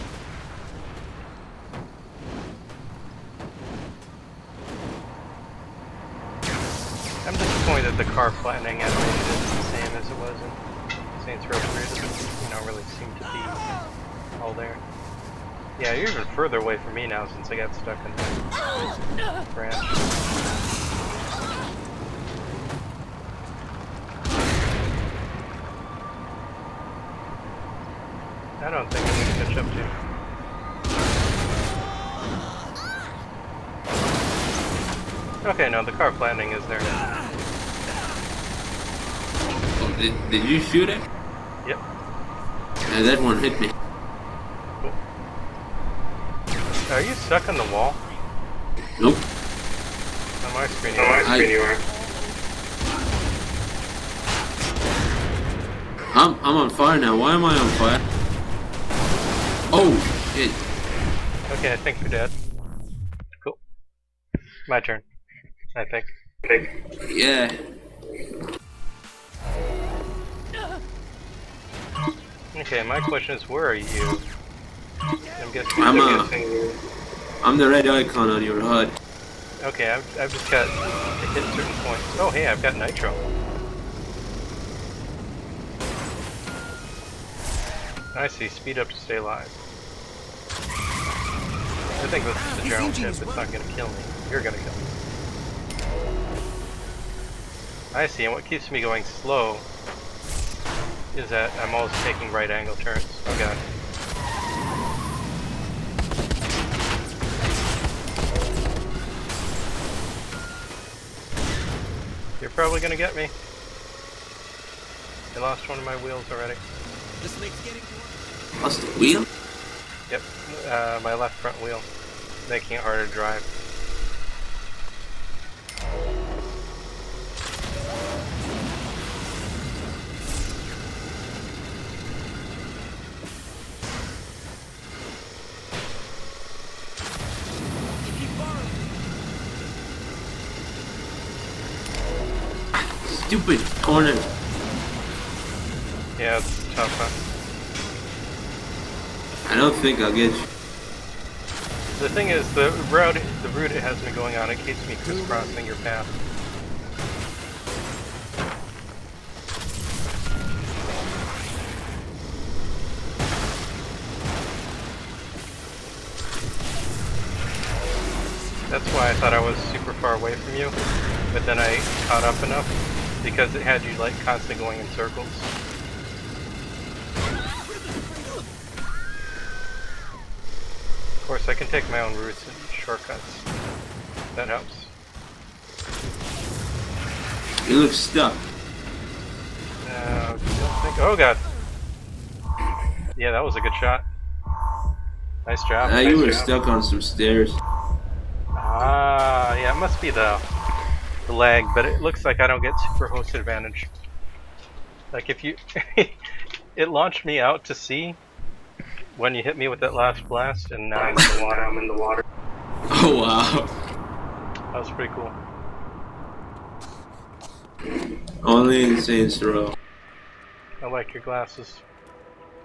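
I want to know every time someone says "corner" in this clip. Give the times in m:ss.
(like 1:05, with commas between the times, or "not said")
2:23.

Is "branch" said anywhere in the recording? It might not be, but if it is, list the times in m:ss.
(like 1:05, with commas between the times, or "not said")
0:19.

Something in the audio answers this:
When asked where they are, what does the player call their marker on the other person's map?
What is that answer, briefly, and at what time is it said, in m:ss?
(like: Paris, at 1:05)
the red icon, at 1:17.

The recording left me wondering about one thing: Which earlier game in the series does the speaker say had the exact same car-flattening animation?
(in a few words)
Saints Row 3.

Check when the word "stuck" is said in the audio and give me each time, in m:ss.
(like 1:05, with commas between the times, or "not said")
0:17, 0:47, 3:07, 3:16.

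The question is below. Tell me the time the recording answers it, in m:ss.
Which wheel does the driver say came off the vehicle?
2:01.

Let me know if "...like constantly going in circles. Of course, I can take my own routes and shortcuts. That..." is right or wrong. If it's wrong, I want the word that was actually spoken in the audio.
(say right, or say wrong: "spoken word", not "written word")
right.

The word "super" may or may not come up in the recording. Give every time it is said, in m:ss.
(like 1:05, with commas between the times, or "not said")
2:49, 3:22.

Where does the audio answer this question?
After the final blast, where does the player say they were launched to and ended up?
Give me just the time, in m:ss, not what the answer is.
3:27.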